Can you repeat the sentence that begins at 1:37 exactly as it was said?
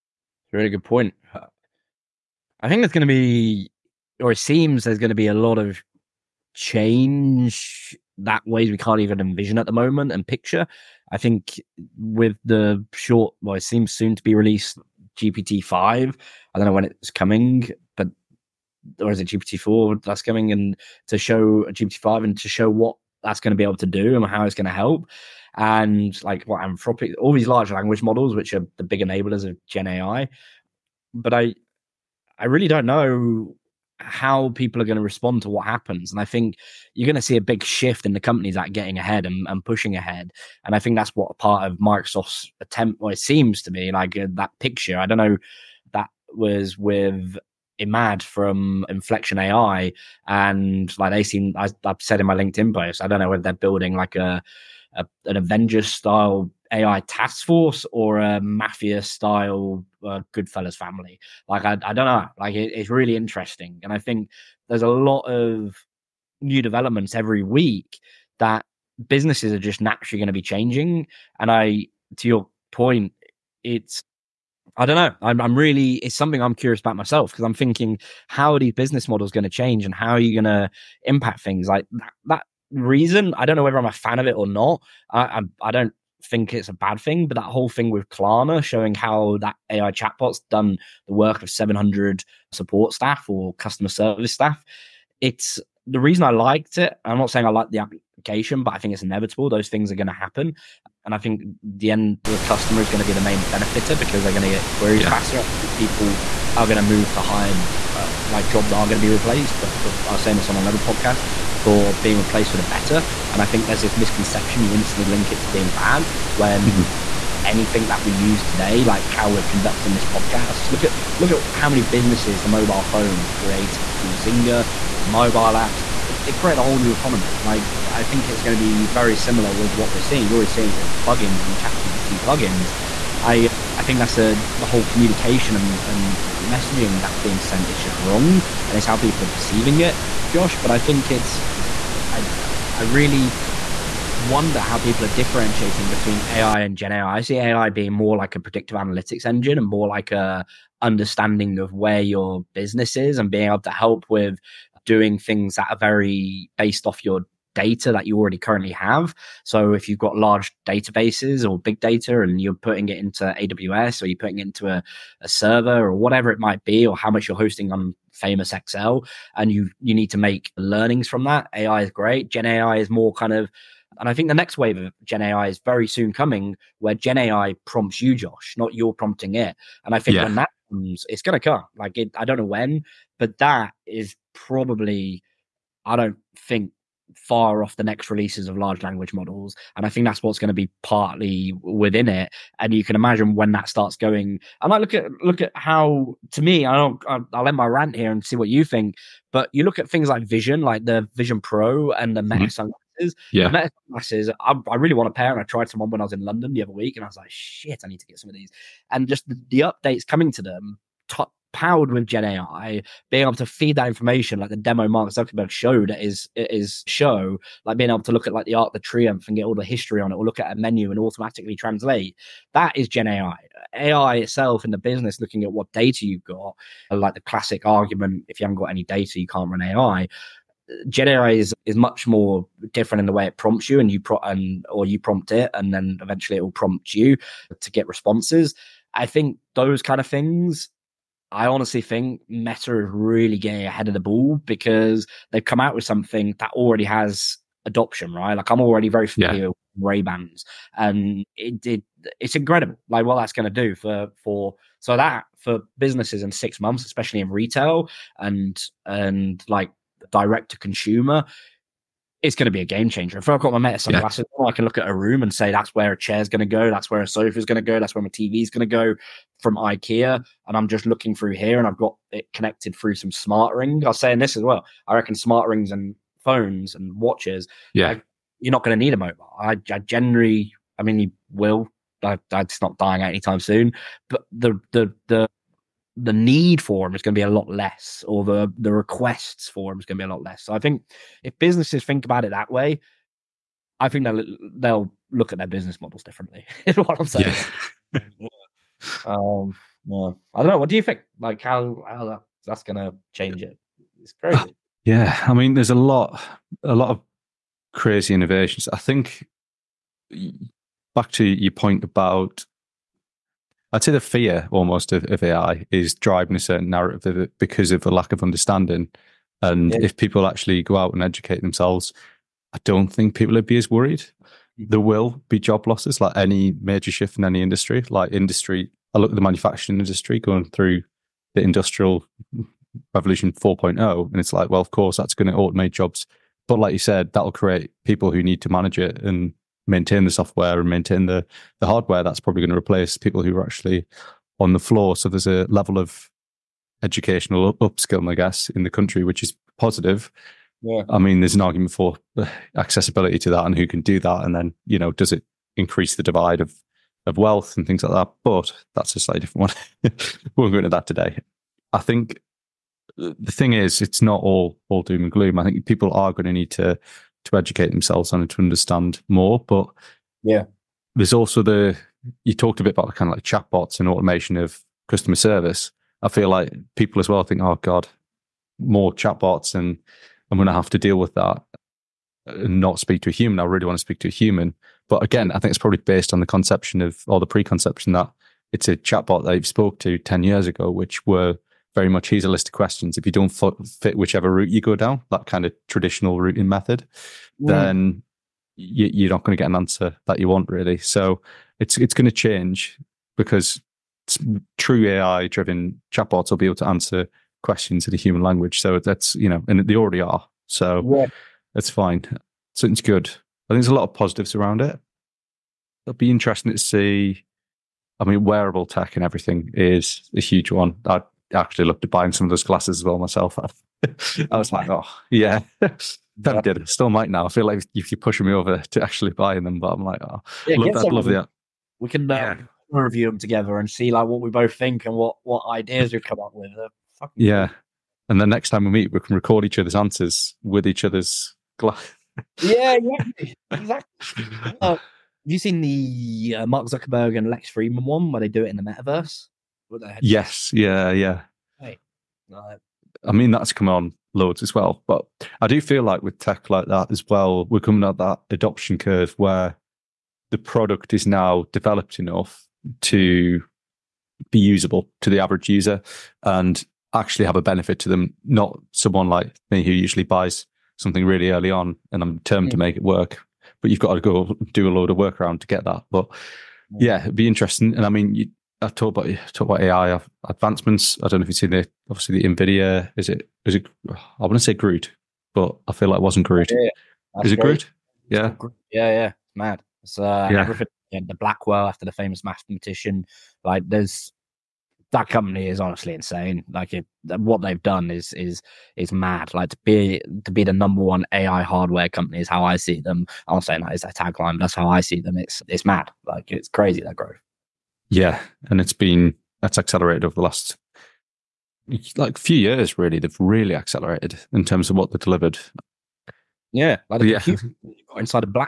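I'm not saying I like the but I think it's inevitable.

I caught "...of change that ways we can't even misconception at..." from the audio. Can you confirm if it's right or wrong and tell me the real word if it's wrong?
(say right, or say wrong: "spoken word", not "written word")
wrong: "envision", not "misconception".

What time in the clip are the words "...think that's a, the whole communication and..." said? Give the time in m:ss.
2:13.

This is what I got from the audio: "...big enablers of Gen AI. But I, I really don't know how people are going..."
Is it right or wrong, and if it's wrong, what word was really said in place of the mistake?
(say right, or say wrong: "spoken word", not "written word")
right.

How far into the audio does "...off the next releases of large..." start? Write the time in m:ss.
3:07.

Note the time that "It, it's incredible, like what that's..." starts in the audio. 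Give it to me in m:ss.
4:12.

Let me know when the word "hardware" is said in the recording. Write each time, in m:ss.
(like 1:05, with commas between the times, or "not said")
5:41, 8:21.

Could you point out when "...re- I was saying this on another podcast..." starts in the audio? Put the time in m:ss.
1:49.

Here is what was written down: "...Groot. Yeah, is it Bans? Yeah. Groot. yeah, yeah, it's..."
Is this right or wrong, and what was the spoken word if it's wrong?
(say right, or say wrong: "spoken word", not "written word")
wrong: "Groot", not "Bans".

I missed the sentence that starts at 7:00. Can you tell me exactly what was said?
I actually looked at buying some of those glasses as well myself.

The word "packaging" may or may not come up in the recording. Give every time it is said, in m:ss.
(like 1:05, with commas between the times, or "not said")
not said.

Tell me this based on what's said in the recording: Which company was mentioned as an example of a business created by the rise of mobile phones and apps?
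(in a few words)
Zynga.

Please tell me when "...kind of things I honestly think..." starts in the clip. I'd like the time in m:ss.
3:59.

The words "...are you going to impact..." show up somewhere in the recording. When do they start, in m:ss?
1:20.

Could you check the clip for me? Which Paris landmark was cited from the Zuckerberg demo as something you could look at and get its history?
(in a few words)
Arc de Triomphe.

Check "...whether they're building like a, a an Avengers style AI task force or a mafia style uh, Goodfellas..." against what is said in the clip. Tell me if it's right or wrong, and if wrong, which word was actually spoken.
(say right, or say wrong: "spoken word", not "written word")
right.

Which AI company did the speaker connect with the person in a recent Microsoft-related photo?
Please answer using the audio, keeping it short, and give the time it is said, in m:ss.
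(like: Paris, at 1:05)
Inflection AI, at 0:48.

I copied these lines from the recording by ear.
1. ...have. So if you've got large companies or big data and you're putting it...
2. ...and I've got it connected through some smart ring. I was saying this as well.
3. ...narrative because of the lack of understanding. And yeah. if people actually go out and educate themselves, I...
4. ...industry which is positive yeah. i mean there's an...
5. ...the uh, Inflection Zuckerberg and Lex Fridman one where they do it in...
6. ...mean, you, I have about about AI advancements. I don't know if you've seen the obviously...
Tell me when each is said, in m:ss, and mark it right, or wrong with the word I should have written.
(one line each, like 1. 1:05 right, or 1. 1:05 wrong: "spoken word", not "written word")
1. 2:38 wrong: "databases", not "companies"
2. 4:31 right
3. 5:16 right
4. 5:48 wrong: "country", not "industry"
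5. 7:25 wrong: "Mark", not "Inflection"
6. 7:57 right.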